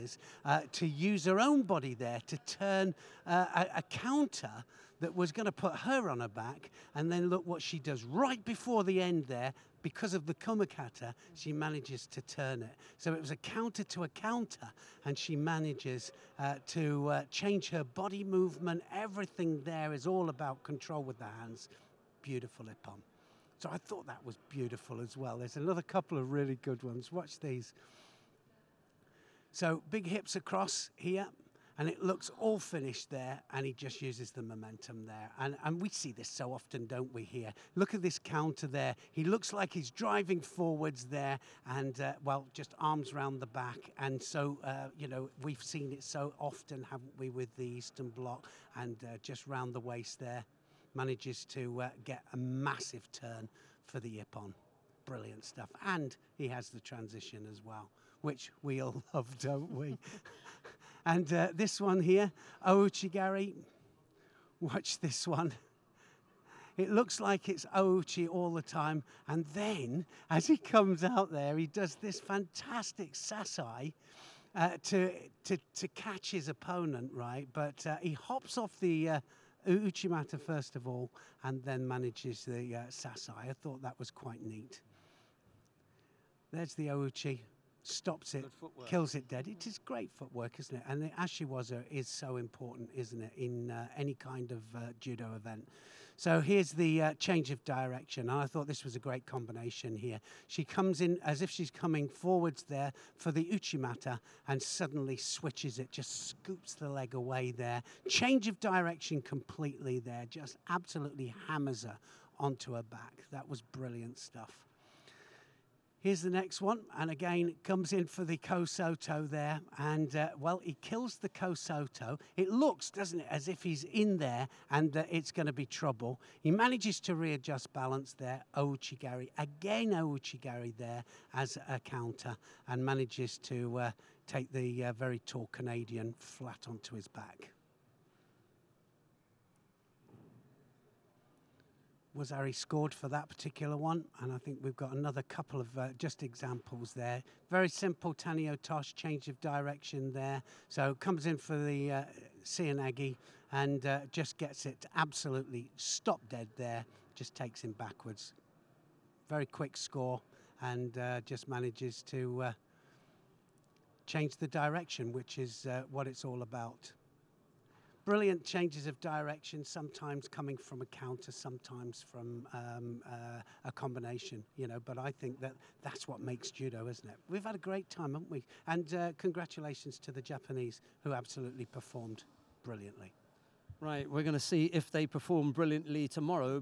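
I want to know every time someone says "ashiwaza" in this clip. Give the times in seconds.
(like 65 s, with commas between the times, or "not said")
91 s.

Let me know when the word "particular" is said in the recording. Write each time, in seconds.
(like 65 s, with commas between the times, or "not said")
143 s.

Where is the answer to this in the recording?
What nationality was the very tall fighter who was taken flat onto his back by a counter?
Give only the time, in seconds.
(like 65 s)
135 s.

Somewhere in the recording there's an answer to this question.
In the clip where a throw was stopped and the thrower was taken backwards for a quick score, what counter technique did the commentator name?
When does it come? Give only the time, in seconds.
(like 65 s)
148 s.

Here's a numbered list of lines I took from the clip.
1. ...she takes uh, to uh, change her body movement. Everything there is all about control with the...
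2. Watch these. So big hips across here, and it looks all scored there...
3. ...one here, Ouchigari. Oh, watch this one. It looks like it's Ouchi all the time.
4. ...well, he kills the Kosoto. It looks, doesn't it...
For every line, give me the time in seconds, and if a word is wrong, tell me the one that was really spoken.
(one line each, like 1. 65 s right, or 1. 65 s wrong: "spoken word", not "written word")
1. 15 s wrong: "manages", not "takes"
2. 27 s wrong: "finished", not "scored"
3. 61 s right
4. 120 s right.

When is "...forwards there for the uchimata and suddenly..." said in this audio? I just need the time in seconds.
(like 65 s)
102 s.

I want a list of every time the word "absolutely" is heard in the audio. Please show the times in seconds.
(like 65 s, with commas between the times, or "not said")
110 s, 154 s, 181 s.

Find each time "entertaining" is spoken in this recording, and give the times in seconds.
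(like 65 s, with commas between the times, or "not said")
not said.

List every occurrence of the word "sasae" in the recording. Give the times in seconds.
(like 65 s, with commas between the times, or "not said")
73 s, 82 s.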